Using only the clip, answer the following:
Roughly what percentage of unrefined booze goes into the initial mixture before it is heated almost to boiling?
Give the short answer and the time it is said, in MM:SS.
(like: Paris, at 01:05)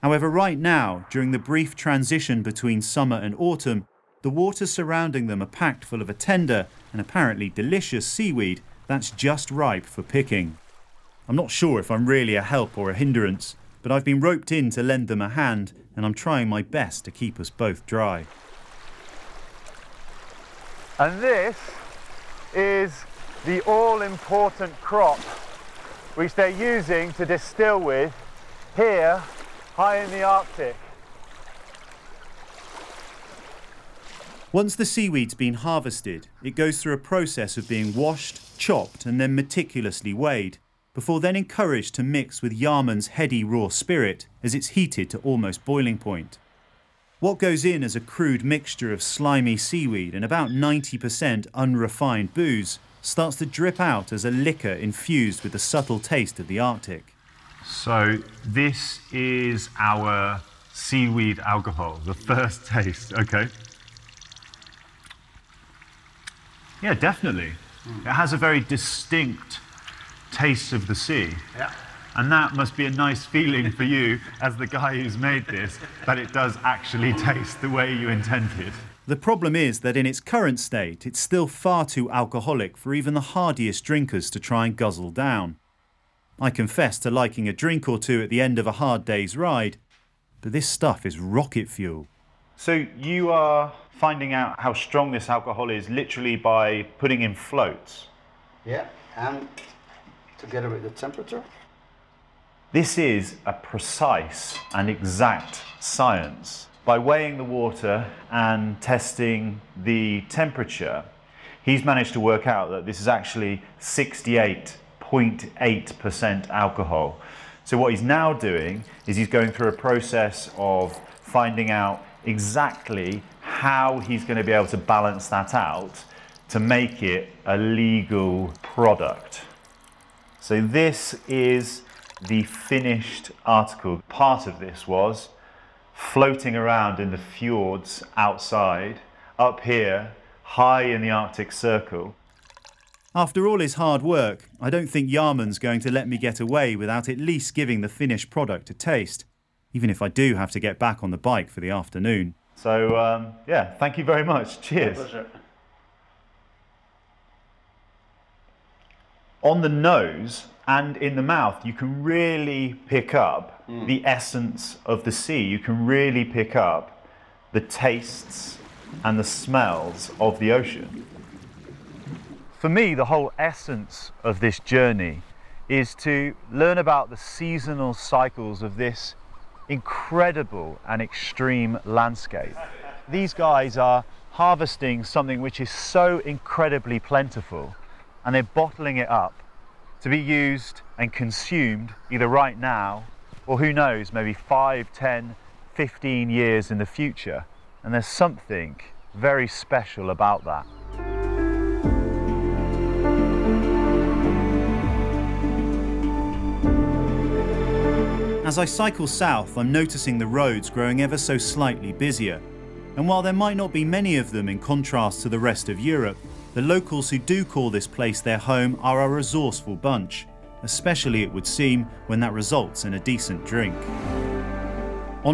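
90%, at 00:50.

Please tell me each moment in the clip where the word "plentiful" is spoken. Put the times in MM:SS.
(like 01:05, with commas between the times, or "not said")
03:06.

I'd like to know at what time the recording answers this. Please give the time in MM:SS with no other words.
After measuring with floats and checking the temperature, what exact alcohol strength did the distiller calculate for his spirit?
01:53.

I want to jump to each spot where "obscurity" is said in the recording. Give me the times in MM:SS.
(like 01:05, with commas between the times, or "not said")
not said.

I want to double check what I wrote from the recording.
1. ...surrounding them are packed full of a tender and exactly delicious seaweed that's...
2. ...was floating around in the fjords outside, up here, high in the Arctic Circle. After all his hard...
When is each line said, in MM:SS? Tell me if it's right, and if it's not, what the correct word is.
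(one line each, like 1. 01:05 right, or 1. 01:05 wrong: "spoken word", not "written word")
1. 00:04 wrong: "apparently", not "exactly"
2. 02:14 right.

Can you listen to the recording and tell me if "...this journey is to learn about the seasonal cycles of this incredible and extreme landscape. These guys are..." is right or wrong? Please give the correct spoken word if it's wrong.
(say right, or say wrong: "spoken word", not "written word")
right.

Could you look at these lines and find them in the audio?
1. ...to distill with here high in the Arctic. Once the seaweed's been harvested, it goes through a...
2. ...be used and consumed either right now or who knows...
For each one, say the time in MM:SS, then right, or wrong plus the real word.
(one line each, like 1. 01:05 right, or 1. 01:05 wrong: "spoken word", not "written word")
1. 00:27 right
2. 03:10 right.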